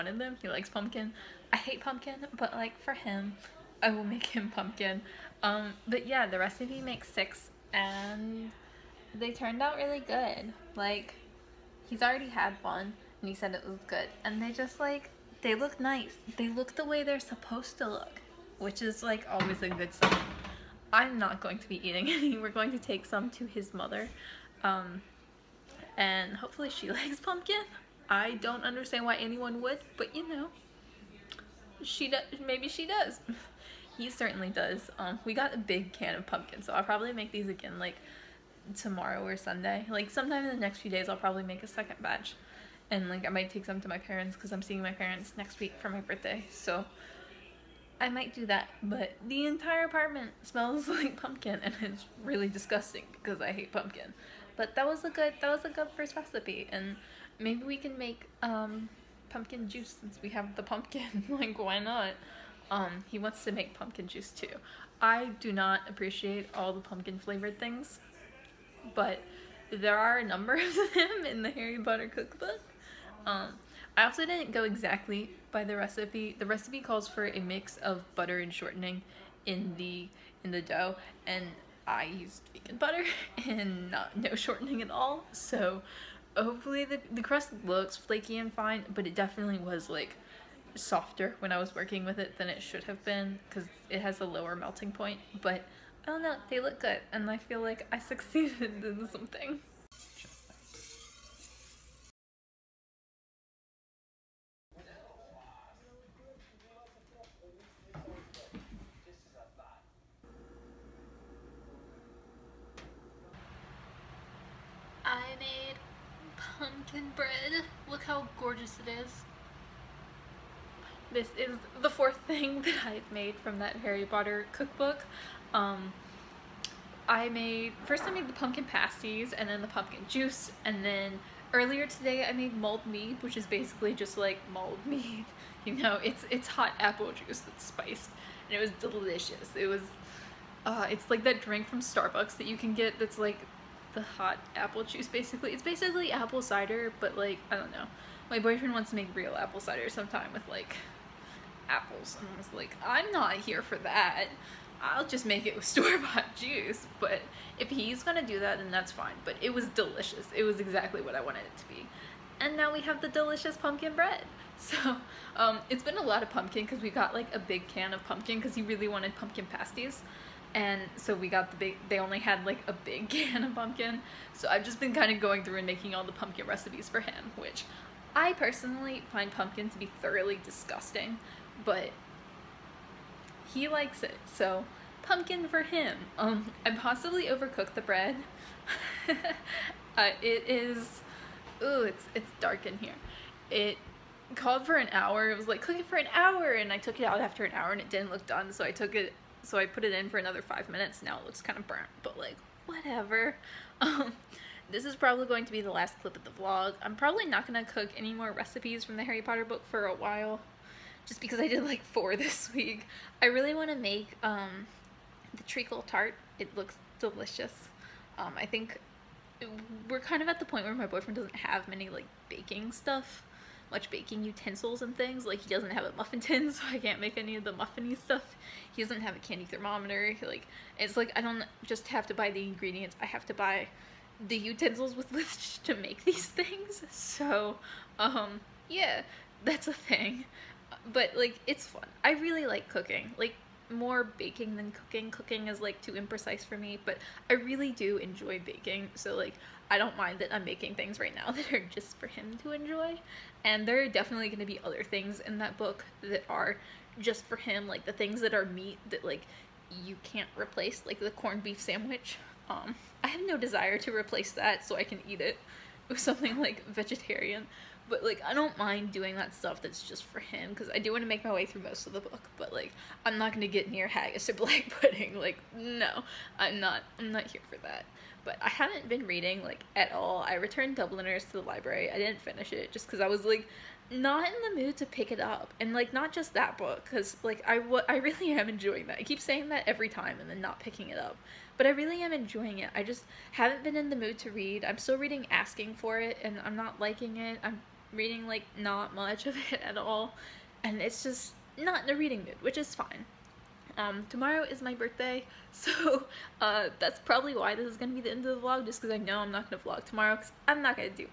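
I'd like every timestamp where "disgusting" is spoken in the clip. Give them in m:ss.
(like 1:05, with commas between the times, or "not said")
0:52, 3:00.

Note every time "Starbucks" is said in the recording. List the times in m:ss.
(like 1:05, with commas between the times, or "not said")
2:21.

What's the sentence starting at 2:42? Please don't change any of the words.
And now we have the delicious pumpkin bread.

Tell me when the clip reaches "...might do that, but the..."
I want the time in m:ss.
0:48.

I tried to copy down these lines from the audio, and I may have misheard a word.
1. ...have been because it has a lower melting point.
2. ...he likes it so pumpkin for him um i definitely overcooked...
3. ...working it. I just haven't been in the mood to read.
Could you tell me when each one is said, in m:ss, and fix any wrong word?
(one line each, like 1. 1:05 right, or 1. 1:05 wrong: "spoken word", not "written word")
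1. 1:32 right
2. 3:03 wrong: "possibly", not "definitely"
3. 4:52 wrong: "enjoying", not "working".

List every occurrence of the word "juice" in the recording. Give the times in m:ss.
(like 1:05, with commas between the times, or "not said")
0:59, 1:04, 2:10, 2:17, 2:24, 2:36.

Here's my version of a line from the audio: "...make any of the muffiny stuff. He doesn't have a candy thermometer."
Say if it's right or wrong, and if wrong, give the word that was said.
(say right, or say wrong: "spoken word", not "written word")
right.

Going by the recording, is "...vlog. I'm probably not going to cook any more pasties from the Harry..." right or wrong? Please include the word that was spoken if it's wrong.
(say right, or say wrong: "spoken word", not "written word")
wrong: "recipes", not "pasties".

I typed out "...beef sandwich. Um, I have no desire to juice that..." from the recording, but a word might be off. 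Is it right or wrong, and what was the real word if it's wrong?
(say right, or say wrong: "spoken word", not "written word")
wrong: "replace", not "juice".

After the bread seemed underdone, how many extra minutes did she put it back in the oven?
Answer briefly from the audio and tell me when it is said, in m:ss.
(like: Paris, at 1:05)
5, at 3:20.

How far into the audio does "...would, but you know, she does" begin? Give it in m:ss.
0:29.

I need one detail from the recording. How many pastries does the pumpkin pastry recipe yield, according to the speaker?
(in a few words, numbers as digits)
6.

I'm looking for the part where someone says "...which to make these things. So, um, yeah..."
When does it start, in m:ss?
3:55.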